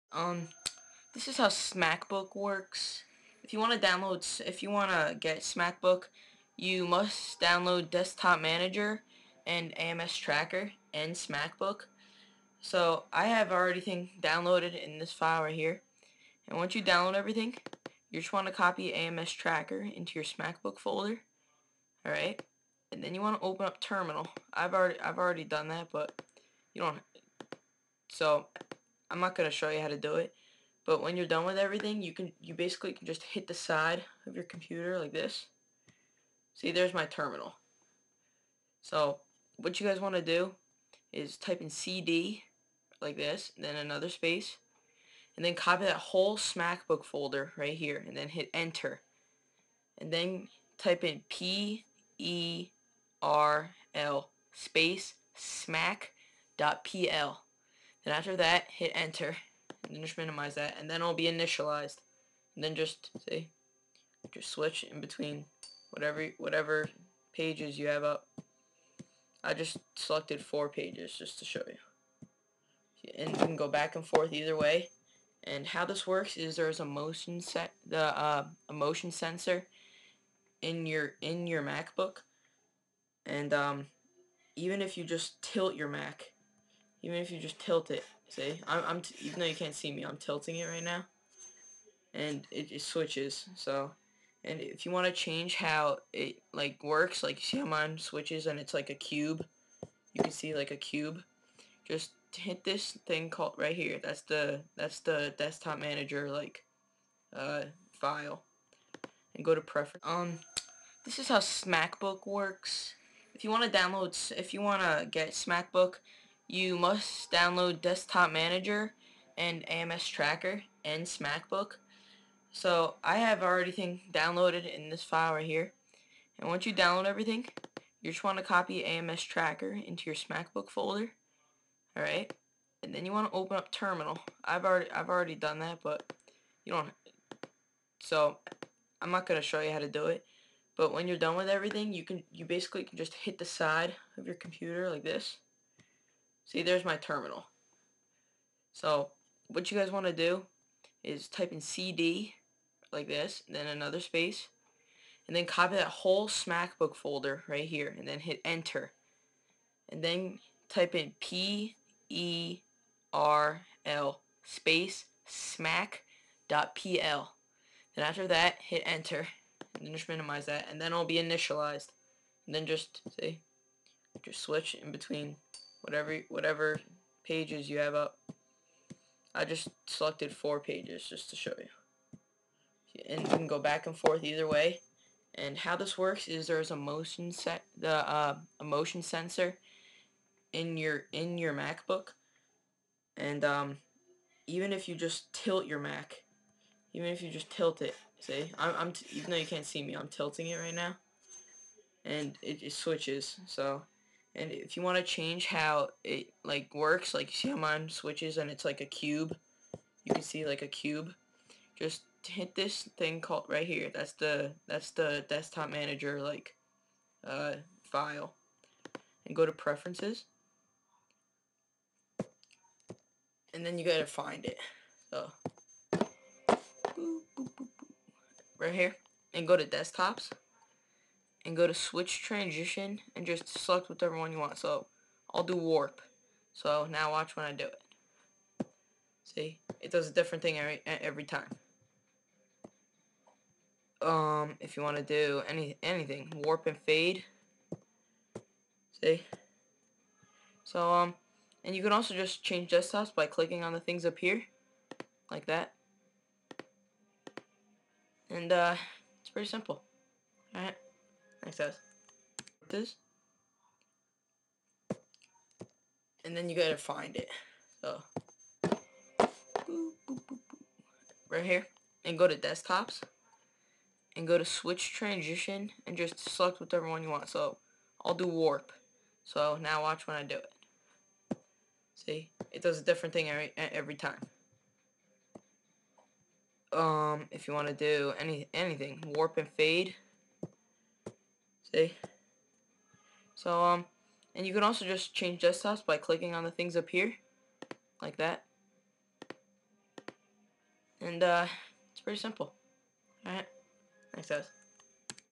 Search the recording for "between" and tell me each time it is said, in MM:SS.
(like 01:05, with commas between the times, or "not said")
01:05, 02:54.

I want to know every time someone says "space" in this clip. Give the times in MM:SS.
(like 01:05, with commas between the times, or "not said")
00:44, 00:54, 02:34, 02:44.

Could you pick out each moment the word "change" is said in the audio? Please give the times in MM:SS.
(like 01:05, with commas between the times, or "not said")
01:35, 03:25, 04:12, 04:55.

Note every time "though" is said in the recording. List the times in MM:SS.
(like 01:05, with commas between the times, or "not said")
01:29, 03:19.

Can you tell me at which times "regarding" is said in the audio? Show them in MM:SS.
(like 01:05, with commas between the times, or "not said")
not said.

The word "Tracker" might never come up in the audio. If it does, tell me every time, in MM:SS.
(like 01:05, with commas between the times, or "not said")
00:10, 00:19, 02:00, 02:09.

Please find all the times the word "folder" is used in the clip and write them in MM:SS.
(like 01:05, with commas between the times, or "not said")
00:20, 00:47, 02:10, 02:36.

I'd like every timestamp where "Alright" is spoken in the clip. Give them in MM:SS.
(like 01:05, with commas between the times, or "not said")
00:22, 02:11, 04:20, 05:03.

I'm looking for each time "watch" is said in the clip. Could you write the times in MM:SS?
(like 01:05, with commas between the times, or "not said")
03:57, 04:39.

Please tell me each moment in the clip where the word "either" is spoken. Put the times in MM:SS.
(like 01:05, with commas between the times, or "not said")
01:14, 03:04.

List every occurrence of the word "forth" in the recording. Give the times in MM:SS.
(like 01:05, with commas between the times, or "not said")
01:14, 03:03.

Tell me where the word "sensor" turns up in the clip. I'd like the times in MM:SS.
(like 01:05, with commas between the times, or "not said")
01:19, 03:09.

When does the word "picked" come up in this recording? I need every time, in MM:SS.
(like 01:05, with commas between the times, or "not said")
not said.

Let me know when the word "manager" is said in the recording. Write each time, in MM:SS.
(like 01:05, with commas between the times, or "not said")
00:08, 01:45, 01:58, 03:35.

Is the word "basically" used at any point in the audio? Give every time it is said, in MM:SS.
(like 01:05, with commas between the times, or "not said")
00:32, 02:22.